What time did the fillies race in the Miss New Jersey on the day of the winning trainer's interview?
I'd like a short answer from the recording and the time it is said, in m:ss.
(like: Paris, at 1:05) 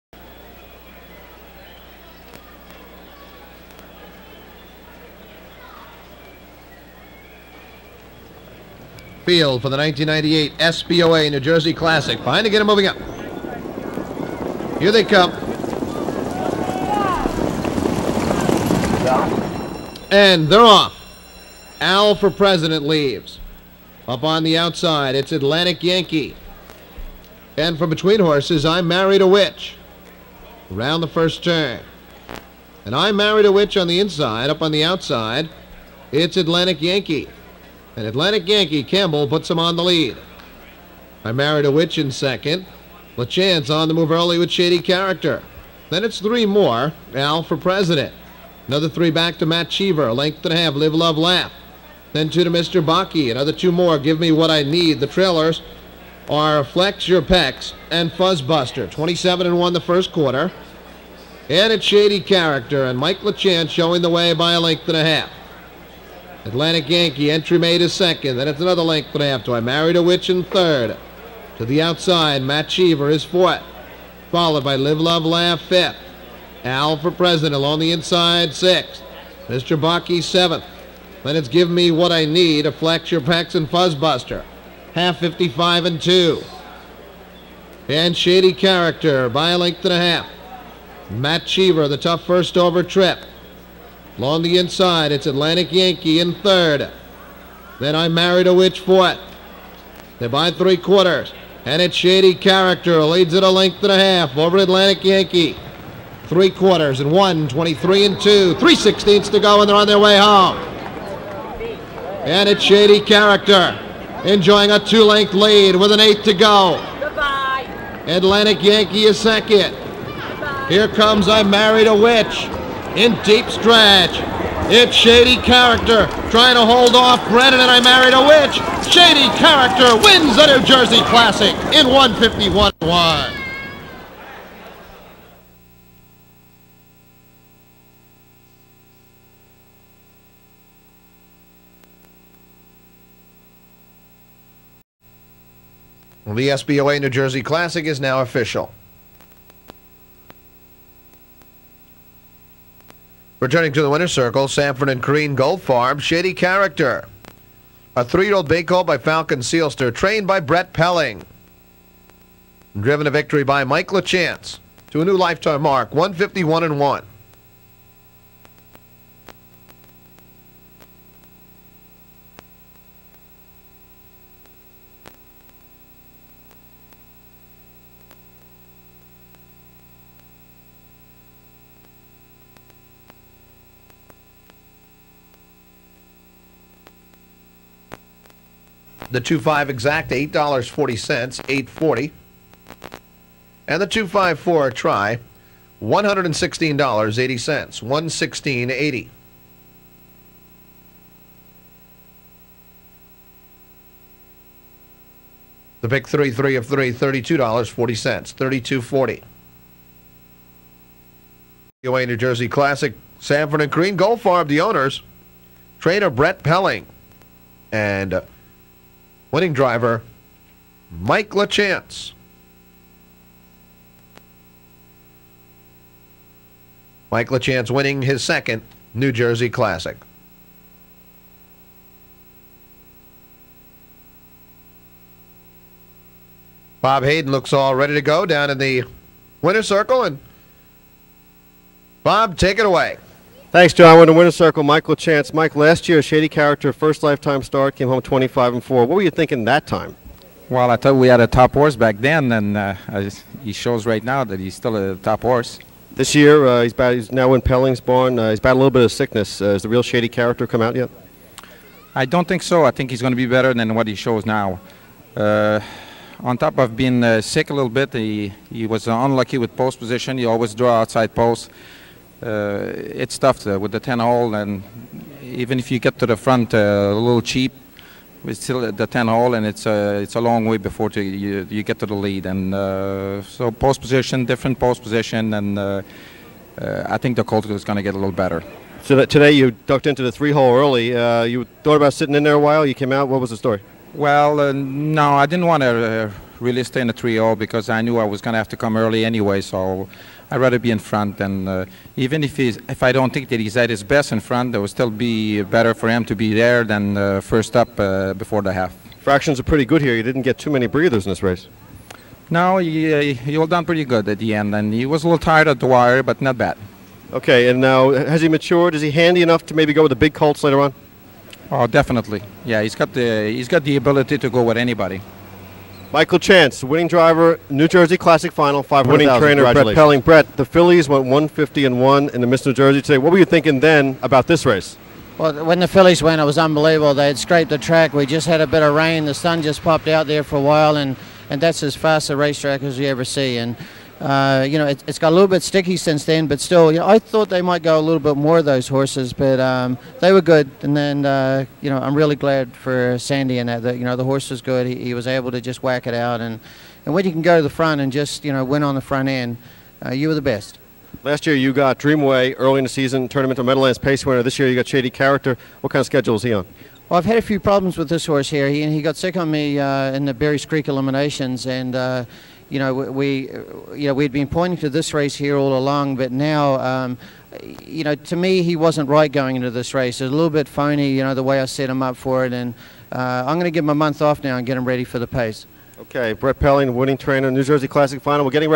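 150 and 1, at 5:31.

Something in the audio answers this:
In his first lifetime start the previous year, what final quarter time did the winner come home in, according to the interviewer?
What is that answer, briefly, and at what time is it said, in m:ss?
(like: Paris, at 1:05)
25 and 4, at 4:08.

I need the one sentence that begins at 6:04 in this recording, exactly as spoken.
This year you got Shady Character.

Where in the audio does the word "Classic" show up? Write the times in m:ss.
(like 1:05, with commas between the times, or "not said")
0:11, 2:11, 2:27, 3:49, 5:27, 6:27.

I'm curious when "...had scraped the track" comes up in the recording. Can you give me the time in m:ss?
5:37.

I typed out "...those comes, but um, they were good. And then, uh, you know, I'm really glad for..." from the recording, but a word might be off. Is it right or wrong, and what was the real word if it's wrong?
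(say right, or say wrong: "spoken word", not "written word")
wrong: "horses", not "comes".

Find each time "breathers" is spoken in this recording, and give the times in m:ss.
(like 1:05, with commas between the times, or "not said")
5:10.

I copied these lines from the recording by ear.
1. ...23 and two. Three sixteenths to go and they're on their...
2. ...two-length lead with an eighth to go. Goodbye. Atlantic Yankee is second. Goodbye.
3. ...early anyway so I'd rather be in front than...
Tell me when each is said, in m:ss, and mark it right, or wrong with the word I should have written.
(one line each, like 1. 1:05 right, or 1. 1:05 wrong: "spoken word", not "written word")
1. 1:47 right
2. 1:54 right
3. 4:58 right.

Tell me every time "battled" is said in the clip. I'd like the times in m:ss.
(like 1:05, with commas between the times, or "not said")
4:18.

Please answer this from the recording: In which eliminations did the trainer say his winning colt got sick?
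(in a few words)
Berry's Creek.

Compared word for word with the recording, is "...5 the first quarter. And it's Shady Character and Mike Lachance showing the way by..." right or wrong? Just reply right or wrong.
wrong.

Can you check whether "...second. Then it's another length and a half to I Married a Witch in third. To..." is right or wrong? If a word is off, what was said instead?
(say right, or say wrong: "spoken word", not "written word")
right.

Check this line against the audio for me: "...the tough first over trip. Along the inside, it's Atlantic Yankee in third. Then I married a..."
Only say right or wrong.
right.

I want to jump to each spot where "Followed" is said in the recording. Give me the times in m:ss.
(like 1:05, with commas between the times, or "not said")
1:14.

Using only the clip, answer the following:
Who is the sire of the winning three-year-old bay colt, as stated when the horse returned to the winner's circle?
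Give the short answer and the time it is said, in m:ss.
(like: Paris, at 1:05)
Falcon Seelster, at 2:38.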